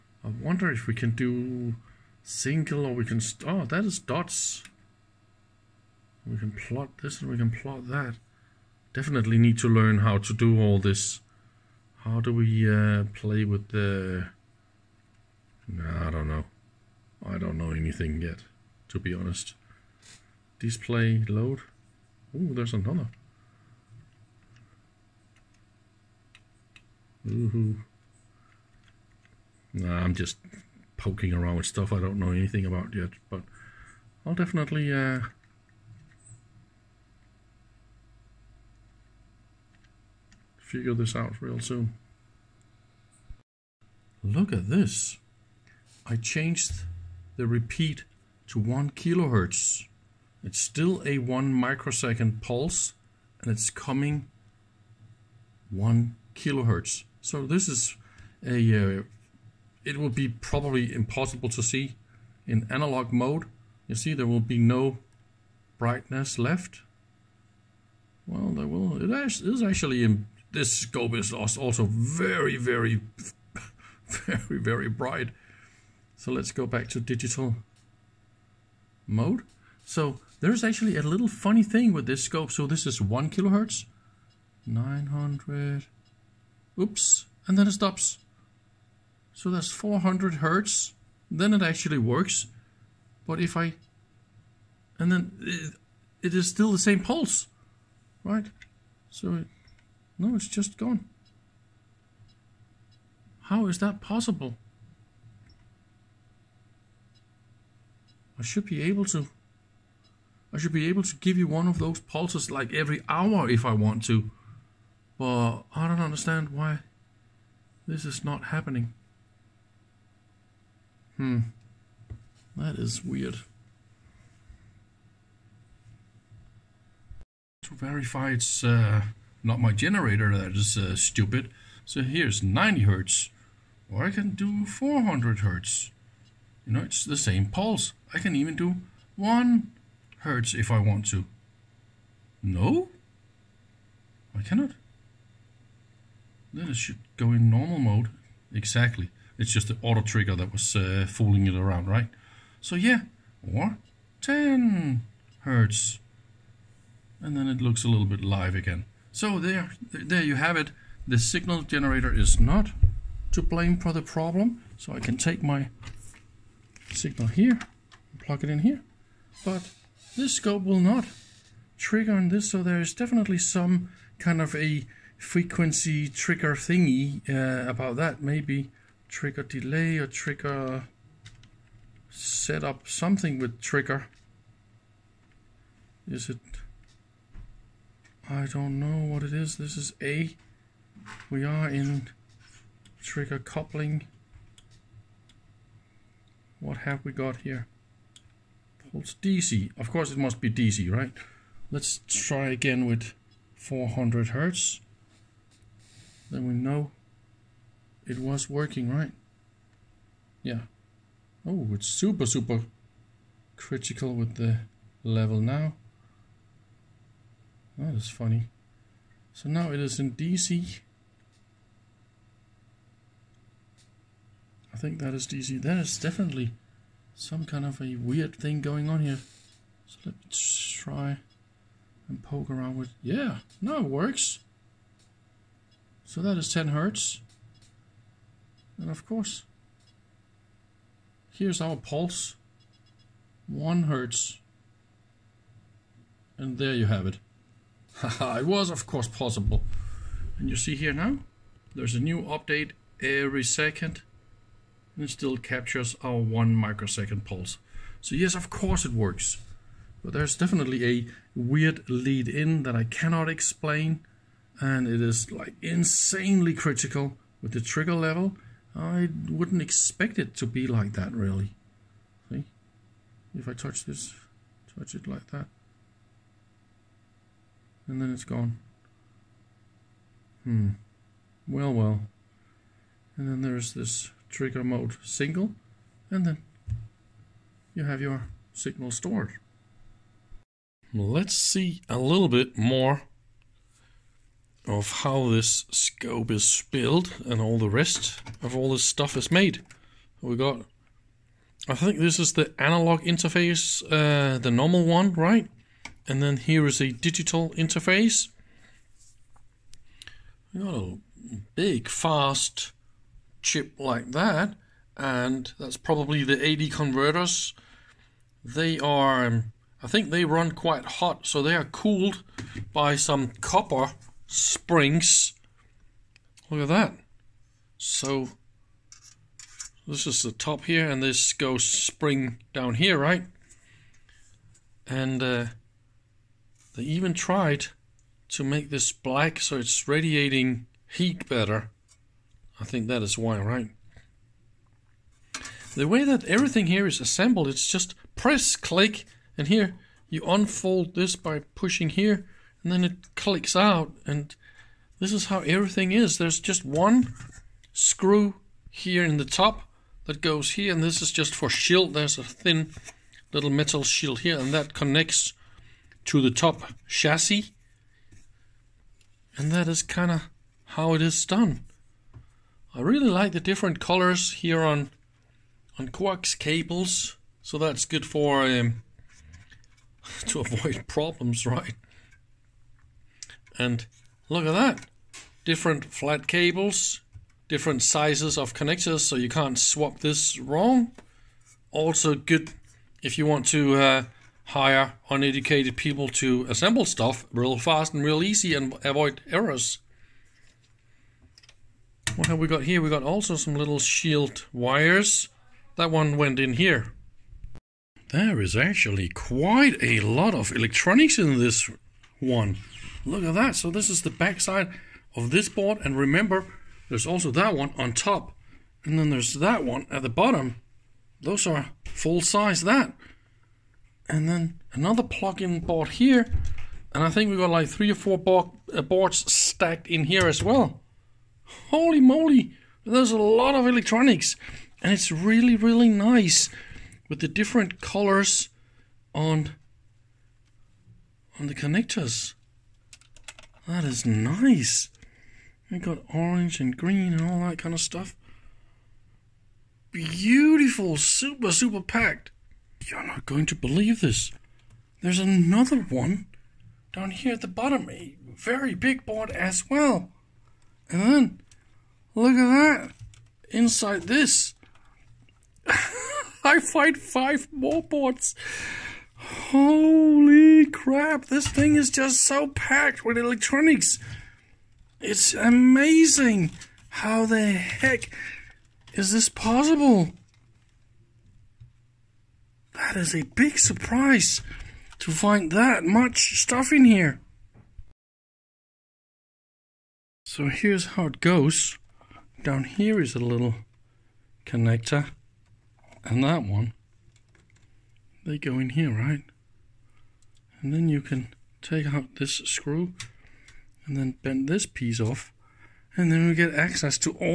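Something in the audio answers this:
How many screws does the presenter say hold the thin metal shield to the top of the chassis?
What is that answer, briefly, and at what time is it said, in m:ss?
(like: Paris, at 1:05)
1, at 5:56.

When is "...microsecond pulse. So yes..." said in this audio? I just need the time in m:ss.
4:16.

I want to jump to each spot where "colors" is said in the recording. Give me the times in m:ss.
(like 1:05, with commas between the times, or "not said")
6:13, 7:17.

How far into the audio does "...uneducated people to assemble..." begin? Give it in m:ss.
6:35.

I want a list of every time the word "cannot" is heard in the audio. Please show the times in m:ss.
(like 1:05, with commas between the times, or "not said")
2:24, 4:22.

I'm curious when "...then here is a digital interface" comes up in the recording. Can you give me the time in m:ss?
5:06.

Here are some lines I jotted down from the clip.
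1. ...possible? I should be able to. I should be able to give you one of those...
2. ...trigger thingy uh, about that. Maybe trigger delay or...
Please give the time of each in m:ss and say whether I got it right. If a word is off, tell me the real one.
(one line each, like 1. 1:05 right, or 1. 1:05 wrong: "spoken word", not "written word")
1. 1:43 right
2. 2:56 right.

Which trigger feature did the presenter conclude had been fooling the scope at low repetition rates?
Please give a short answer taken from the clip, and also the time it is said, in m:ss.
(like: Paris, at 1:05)
auto trigger, at 2:29.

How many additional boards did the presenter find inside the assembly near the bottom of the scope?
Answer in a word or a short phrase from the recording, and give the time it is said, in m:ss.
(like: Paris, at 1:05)
5, at 7:46.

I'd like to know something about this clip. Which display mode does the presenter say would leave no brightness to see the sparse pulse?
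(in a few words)
analog mode.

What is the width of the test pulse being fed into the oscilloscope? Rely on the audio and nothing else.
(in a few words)
1 microsecond.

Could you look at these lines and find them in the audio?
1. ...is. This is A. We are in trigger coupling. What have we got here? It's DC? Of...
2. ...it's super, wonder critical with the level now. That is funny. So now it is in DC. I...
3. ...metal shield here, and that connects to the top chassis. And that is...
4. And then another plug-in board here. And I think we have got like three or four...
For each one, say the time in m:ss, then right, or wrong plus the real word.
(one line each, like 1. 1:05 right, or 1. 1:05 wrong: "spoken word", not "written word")
1. 3:09 right
2. 3:31 wrong: "super", not "wonder"
3. 6:03 right
4. 7:04 right.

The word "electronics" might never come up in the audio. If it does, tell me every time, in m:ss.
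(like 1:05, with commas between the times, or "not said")
6:50, 7:13, 7:53.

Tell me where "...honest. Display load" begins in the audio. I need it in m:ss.
0:19.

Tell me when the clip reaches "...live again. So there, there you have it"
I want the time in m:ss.
2:38.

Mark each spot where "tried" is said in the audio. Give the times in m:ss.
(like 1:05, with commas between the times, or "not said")
5:37.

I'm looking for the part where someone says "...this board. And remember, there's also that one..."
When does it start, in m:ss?
6:55.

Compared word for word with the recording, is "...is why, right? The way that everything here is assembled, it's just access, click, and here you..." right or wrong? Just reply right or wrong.
wrong.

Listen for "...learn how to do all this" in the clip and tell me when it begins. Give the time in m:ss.
0:09.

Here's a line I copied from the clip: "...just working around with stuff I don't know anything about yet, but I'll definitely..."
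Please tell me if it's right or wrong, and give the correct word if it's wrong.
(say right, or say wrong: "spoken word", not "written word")
wrong: "poking", not "working".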